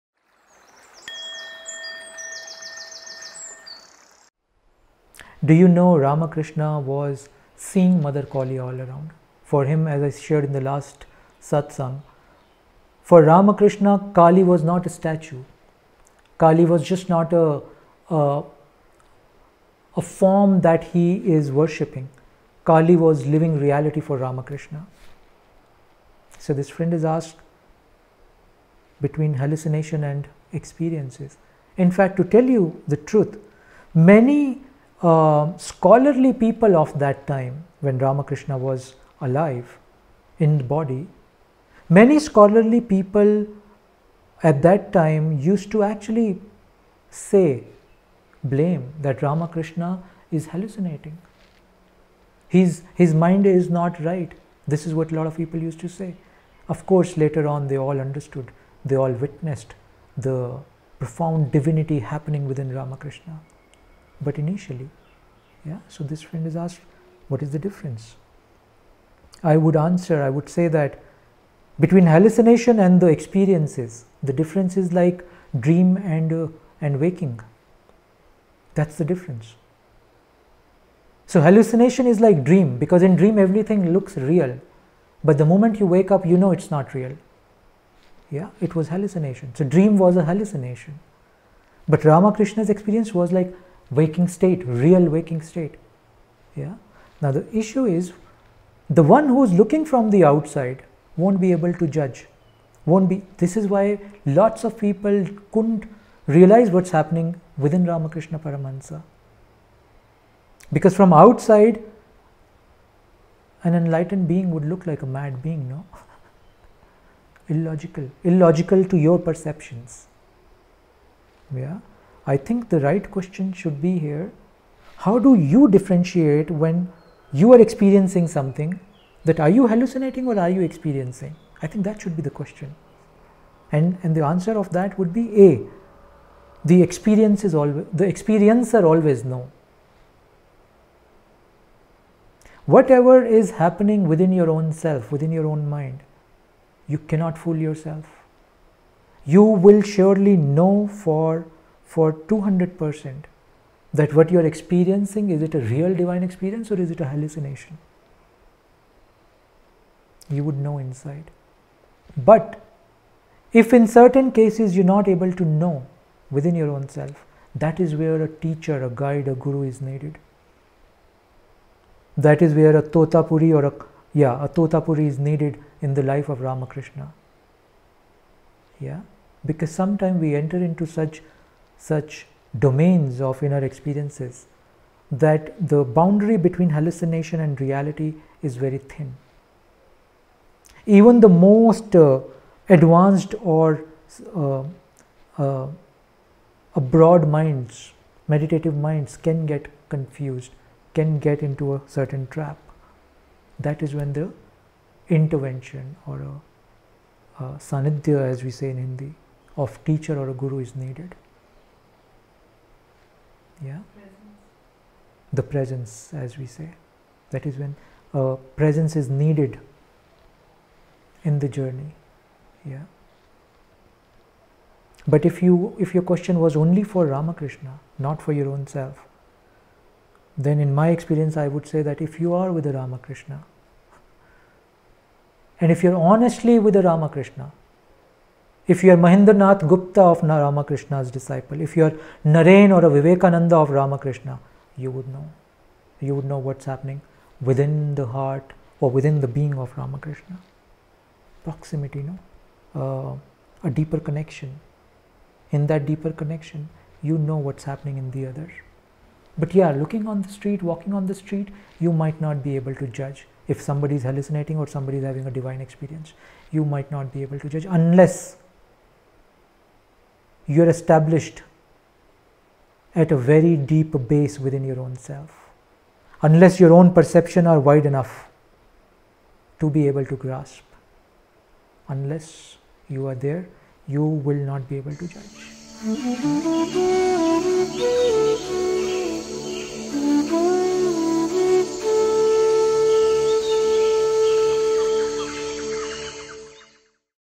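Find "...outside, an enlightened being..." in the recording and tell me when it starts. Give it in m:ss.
1:51.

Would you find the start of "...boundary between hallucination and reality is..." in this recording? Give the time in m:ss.
3:05.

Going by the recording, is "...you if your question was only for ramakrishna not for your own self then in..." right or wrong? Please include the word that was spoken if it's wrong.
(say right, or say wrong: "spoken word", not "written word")
right.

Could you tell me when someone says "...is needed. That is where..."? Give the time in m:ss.
2:49.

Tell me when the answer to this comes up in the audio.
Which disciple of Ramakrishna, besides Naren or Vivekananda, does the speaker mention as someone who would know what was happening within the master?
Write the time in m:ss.
3:59.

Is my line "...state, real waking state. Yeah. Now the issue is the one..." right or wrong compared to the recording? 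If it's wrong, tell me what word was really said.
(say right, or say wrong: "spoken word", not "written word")
right.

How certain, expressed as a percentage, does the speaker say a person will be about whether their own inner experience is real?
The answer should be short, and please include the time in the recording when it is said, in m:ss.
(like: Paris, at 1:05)
200%, at 2:32.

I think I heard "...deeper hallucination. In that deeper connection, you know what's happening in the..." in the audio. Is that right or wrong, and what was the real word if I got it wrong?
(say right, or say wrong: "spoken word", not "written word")
wrong: "connection", not "hallucination".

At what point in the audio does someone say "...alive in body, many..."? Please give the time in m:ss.
0:39.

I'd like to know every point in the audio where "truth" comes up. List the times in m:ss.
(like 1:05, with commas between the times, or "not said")
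0:32.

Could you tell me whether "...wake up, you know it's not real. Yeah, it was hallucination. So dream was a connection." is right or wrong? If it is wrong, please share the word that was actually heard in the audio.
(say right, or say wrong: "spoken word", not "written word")
wrong: "hallucination", not "connection".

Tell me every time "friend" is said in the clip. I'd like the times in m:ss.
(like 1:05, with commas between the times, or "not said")
0:26, 1:06.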